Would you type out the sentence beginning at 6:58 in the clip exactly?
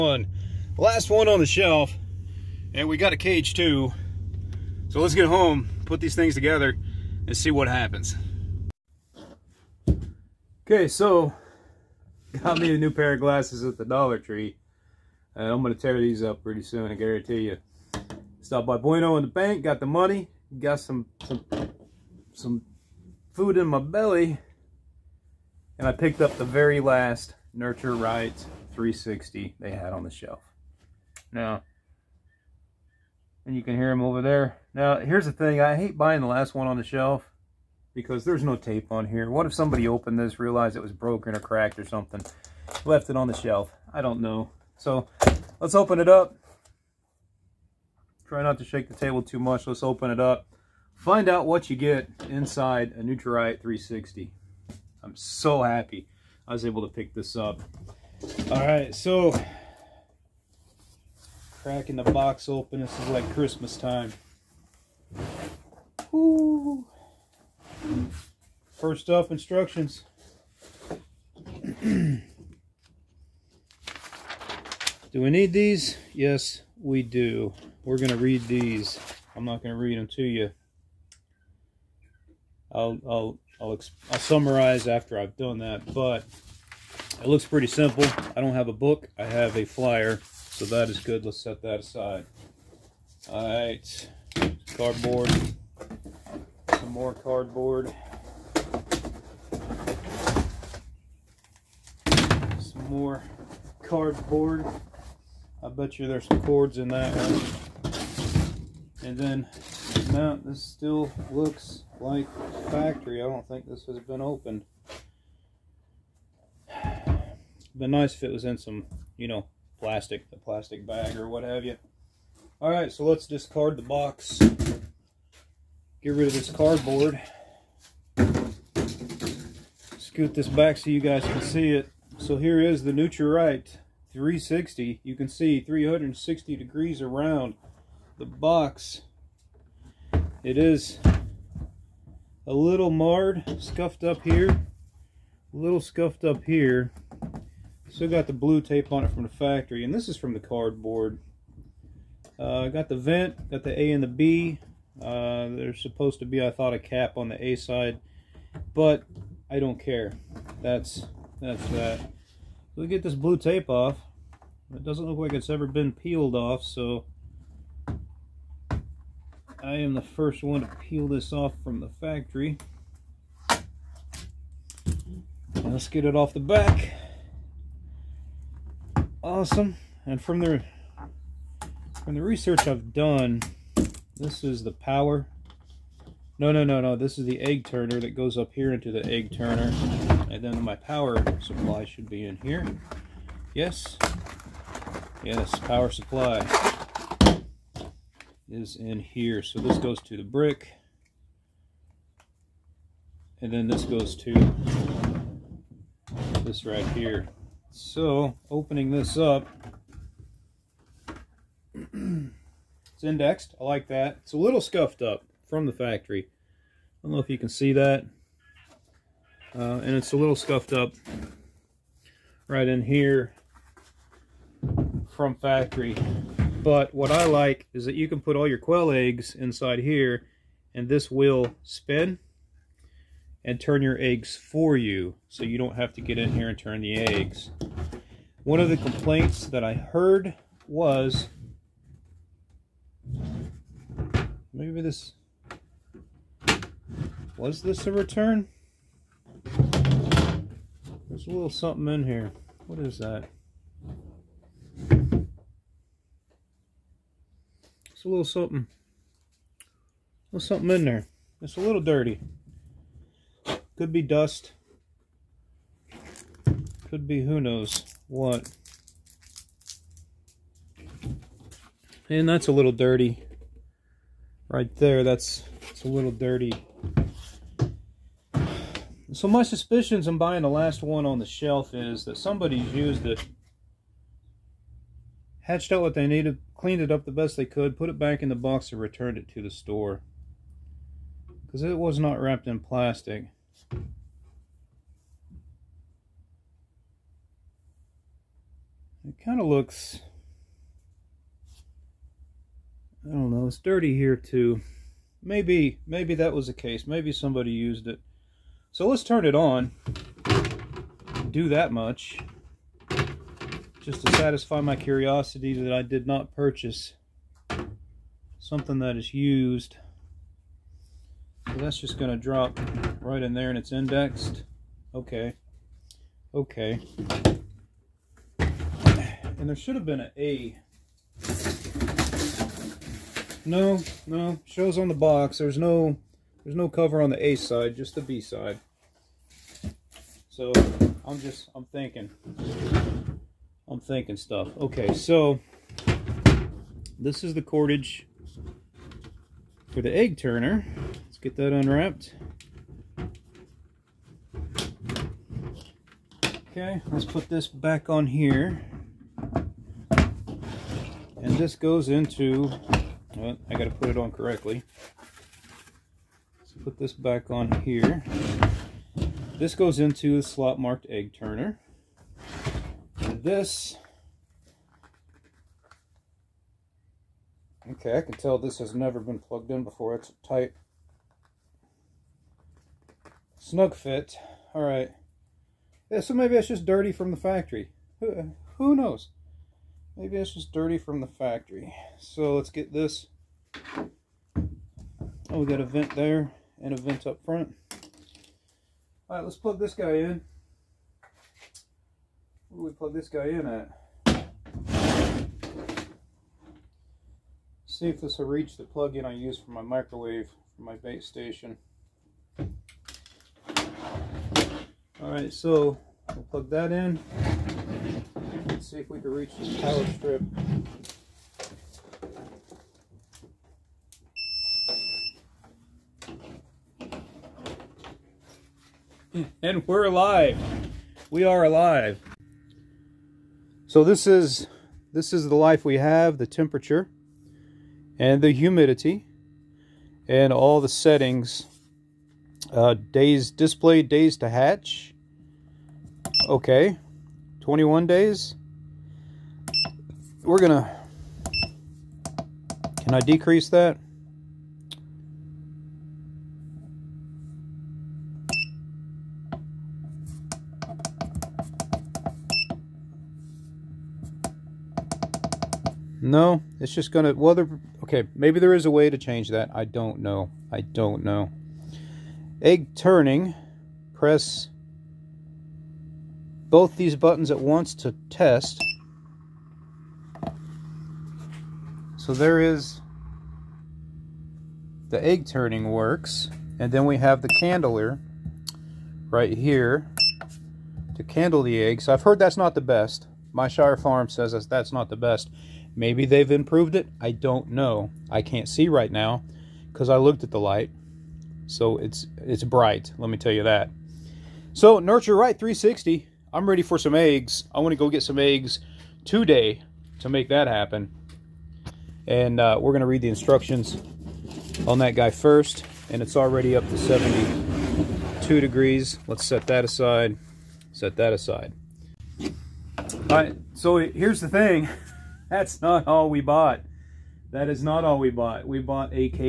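Let's see if we can reach this power strip.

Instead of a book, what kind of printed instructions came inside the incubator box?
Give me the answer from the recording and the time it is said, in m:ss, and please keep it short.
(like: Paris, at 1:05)
a flyer, at 1:29.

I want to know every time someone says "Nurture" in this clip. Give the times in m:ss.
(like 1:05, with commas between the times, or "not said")
0:27, 2:12, 8:24.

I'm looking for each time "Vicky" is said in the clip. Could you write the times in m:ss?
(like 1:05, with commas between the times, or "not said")
not said.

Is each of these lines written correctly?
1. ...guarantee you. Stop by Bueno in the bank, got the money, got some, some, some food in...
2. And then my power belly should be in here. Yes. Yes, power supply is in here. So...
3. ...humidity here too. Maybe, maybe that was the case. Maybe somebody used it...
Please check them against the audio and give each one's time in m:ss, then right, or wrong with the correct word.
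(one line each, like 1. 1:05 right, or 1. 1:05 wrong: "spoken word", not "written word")
1. 0:16 right
2. 3:10 wrong: "supply", not "belly"
3. 5:03 wrong: "dirty", not "humidity".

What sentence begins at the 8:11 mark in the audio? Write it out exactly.
I've heard that's not the best.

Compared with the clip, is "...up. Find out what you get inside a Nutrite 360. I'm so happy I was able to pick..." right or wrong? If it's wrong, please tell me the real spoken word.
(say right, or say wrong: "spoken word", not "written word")
right.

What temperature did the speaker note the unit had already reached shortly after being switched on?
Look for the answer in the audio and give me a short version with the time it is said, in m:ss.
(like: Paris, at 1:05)
72 degrees, at 8:36.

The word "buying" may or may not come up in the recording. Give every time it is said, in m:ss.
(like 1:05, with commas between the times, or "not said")
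0:35, 4:40.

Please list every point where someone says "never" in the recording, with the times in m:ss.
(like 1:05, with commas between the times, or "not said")
6:18.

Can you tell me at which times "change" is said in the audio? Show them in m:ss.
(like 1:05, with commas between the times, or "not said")
7:48.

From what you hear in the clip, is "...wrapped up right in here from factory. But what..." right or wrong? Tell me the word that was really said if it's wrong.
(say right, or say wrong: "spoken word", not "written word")
wrong: "scuffed", not "wrapped".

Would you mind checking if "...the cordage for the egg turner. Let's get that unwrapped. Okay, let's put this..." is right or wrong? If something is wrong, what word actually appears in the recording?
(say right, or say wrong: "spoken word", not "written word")
right.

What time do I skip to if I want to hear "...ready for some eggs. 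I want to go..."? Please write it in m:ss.
8:26.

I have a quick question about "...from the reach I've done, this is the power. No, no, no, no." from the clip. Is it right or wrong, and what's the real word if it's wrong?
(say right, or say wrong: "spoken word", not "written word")
wrong: "research", not "reach".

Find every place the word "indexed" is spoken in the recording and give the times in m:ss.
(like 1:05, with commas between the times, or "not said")
3:33, 5:23.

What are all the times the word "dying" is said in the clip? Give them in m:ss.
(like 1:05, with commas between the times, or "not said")
not said.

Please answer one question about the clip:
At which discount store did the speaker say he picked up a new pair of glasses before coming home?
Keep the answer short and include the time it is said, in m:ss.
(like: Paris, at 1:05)
Dollar Tree, at 0:13.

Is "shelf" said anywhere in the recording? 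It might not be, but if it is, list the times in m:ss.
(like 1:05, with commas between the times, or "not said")
0:01, 0:30, 0:36, 0:43, 4:41.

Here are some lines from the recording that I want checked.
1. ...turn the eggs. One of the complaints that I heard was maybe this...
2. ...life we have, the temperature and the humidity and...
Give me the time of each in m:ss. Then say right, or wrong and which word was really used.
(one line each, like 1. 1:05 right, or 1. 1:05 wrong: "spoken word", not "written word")
1. 3:56 right
2. 7:15 right.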